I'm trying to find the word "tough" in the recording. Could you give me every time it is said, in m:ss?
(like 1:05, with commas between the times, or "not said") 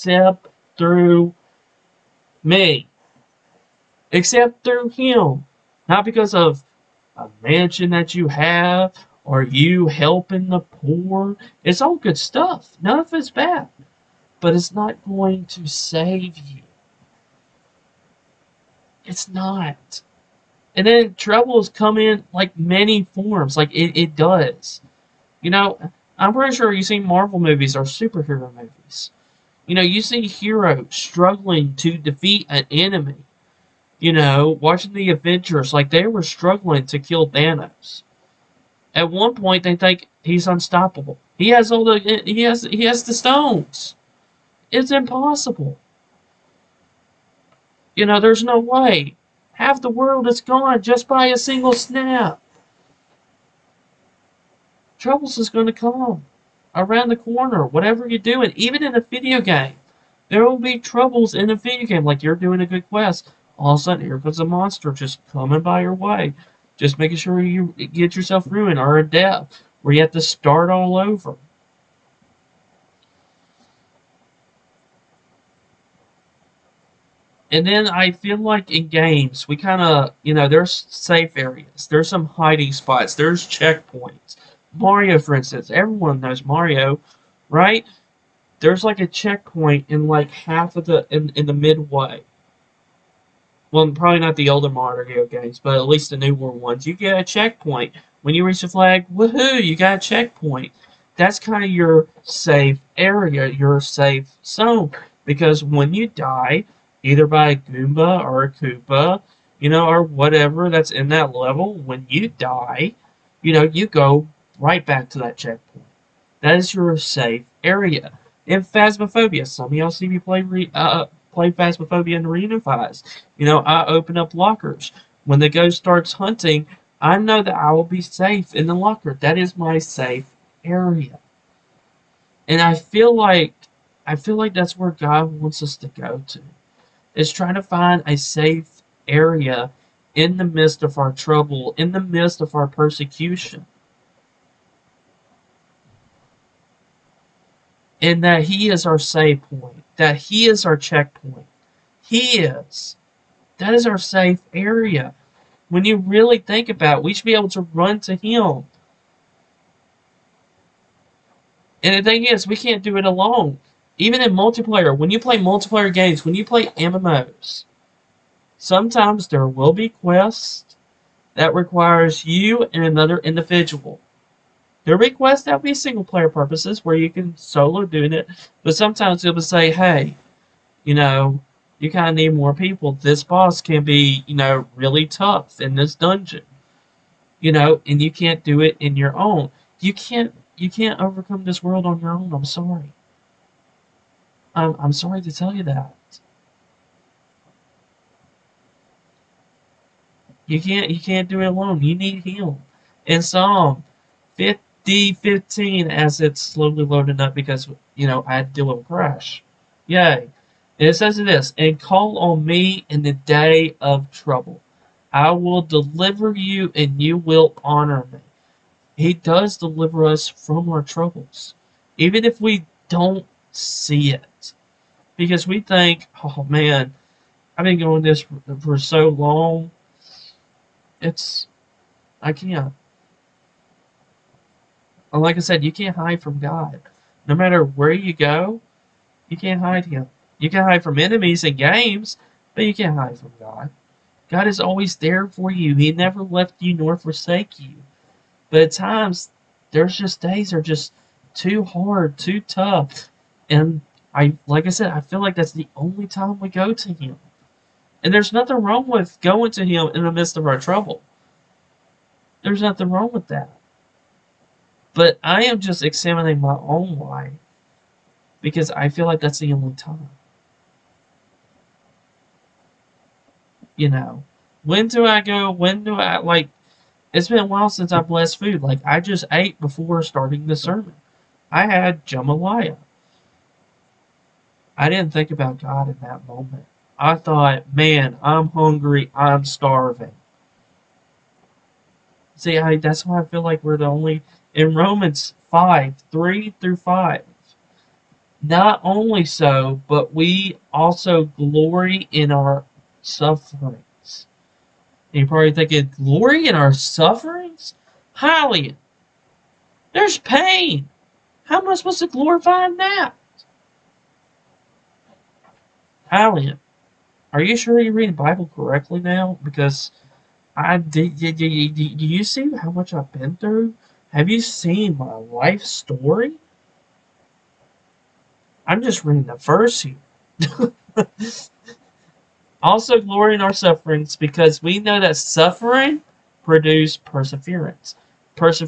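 3:05, 4:12.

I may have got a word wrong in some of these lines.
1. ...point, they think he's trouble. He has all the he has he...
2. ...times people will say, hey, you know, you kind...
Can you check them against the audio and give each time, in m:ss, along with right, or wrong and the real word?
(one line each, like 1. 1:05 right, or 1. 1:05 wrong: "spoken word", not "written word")
1. 0:39 wrong: "unstoppable", not "trouble"
2. 2:58 wrong: "sometimes", not "times".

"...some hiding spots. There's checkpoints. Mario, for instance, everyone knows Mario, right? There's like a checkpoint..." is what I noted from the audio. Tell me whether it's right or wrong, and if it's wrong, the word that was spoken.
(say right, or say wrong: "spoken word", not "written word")
right.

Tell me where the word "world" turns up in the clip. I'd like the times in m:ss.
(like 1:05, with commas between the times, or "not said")
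0:49, 3:11.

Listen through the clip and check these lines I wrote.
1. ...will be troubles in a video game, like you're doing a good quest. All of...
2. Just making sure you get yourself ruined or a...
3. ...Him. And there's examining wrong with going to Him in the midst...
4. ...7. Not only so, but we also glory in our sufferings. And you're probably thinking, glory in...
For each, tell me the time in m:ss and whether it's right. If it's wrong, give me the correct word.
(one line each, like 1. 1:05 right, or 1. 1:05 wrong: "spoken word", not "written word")
1. 1:00 right
2. 1:06 right
3. 4:16 wrong: "nothing", not "examining"
4. 4:56 wrong: "5", not "7".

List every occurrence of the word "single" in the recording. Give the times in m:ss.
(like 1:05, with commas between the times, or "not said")
0:51, 2:55.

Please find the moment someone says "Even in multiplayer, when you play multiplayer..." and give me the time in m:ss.
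2:43.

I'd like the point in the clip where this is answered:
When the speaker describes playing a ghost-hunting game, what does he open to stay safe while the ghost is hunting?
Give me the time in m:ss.
2:04.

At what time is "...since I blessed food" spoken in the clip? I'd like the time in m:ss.
4:37.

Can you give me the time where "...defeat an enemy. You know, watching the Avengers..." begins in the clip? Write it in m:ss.
0:31.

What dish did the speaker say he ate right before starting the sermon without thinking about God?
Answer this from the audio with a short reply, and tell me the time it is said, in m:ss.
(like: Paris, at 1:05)
Jambalaya, at 4:42.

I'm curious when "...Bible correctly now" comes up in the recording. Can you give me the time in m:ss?
5:18.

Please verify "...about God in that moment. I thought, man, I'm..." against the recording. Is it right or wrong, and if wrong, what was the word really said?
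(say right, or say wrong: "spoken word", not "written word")
right.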